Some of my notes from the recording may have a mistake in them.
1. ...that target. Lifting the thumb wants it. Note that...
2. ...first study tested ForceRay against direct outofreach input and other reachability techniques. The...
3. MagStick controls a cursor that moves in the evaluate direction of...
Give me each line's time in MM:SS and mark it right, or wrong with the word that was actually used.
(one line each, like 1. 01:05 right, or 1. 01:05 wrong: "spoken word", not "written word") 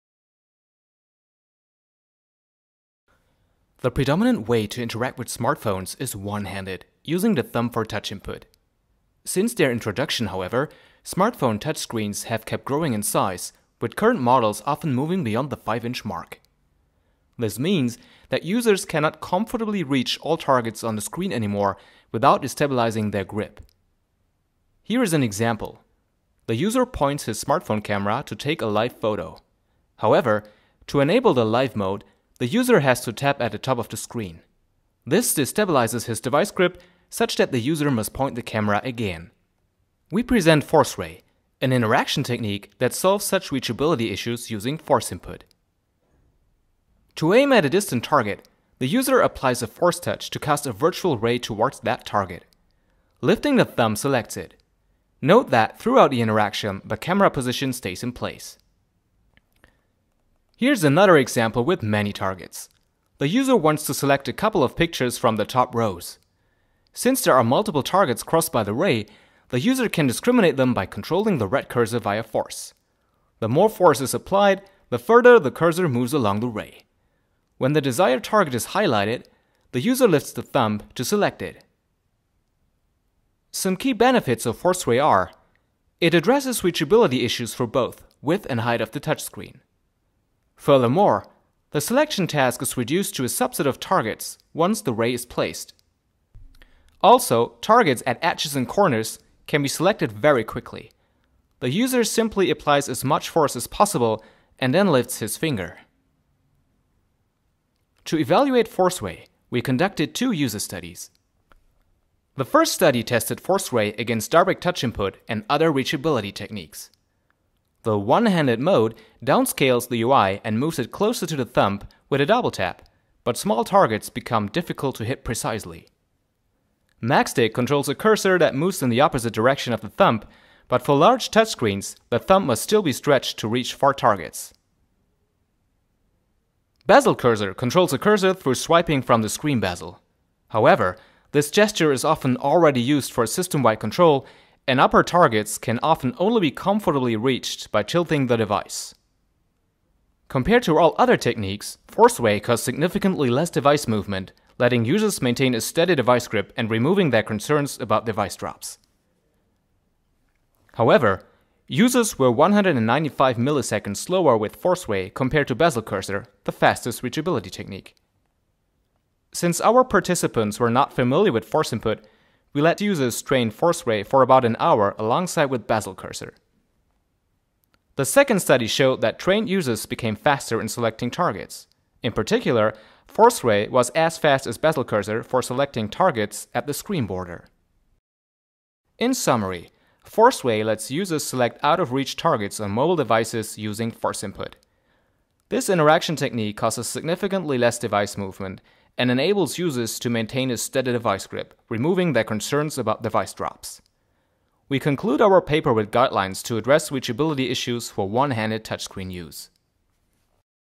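1. 00:51 wrong: "selects", not "wants"
2. 01:52 wrong: "touch", not "outofreach"
3. 02:07 wrong: "opposite", not "evaluate".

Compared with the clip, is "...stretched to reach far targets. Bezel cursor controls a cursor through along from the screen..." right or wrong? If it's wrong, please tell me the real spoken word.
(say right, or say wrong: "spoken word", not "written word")
wrong: "swiping", not "along".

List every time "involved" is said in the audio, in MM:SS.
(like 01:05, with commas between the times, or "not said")
not said.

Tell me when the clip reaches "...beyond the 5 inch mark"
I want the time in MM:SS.
00:15.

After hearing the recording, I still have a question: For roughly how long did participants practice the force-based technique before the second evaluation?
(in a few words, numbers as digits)
about an hour.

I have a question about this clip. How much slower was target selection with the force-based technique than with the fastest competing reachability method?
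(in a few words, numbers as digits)
195 milliseconds.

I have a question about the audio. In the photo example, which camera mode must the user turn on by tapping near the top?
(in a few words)
live mode.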